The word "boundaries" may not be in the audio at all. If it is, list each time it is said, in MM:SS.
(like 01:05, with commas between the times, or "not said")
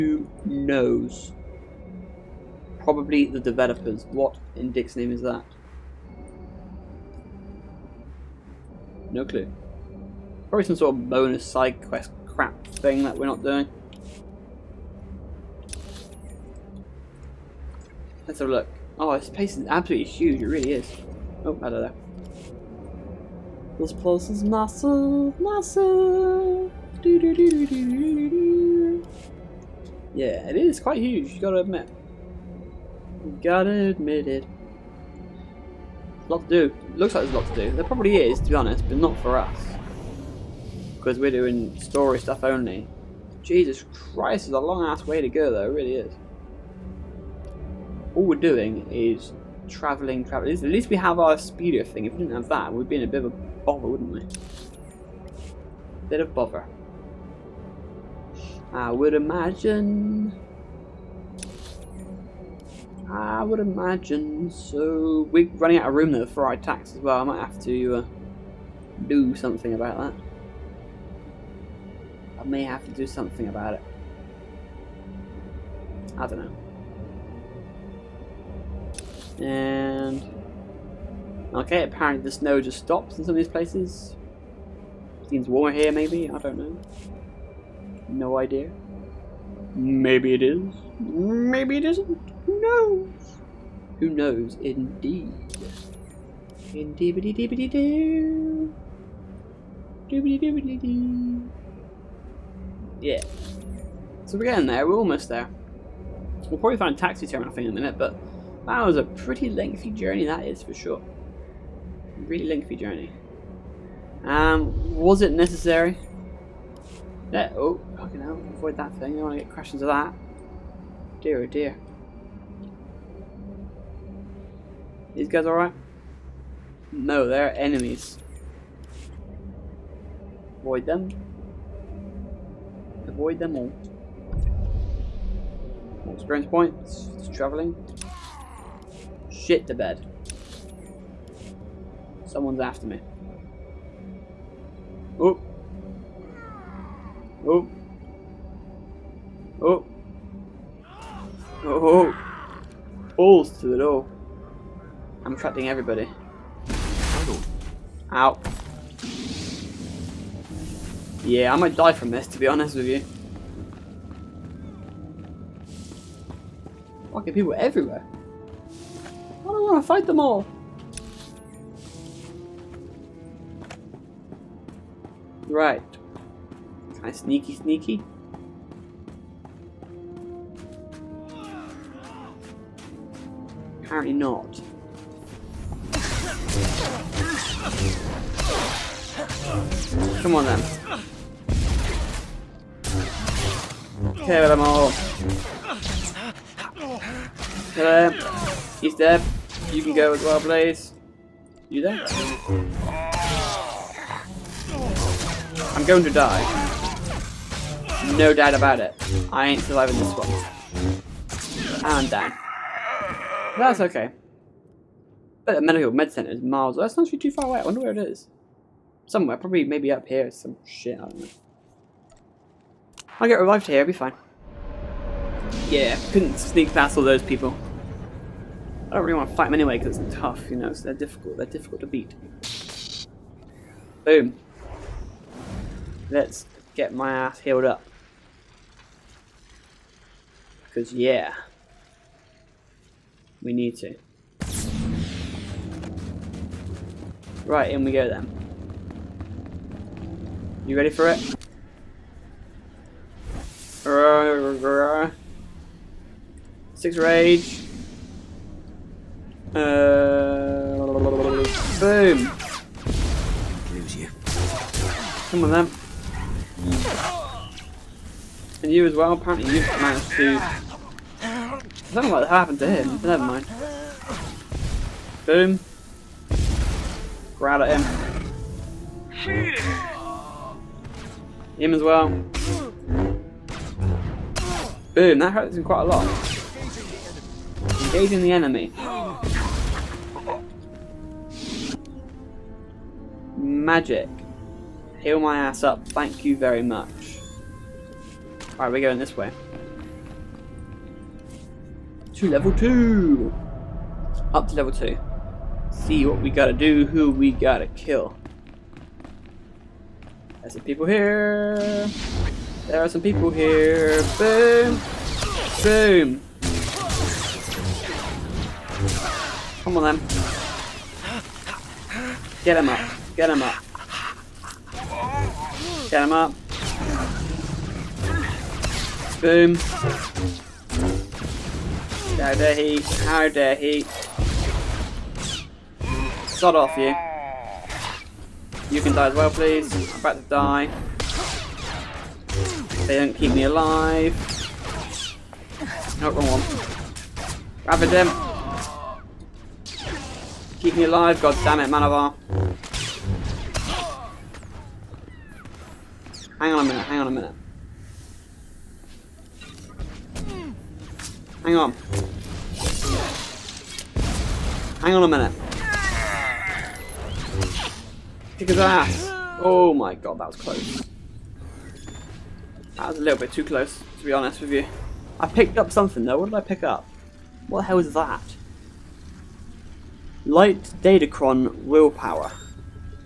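not said.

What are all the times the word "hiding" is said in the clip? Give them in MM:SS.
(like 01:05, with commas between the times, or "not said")
not said.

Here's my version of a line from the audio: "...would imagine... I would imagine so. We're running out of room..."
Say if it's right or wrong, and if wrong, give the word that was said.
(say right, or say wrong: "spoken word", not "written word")
right.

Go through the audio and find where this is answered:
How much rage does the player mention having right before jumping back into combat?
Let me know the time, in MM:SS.
04:16.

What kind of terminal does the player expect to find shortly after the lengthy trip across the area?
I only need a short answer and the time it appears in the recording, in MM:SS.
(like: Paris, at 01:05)
taxi terminal, at 01:46.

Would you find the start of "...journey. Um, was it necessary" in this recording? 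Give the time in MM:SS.
01:52.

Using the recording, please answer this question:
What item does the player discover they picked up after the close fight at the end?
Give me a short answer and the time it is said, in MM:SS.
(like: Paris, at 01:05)
Light Datacron willpower, at 06:20.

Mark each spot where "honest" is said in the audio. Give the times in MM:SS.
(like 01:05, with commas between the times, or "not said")
00:38, 02:42, 06:14.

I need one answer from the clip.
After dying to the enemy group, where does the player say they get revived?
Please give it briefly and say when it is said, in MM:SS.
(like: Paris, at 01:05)
medical med center, at 03:35.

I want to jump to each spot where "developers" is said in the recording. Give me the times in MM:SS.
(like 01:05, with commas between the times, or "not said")
00:03.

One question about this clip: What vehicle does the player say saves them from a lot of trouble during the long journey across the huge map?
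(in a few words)
speeder.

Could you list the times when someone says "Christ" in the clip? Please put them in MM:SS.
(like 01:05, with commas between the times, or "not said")
00:43.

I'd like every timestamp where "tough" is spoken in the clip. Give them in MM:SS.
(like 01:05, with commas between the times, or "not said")
03:50.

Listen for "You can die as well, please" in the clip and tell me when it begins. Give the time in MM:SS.
05:38.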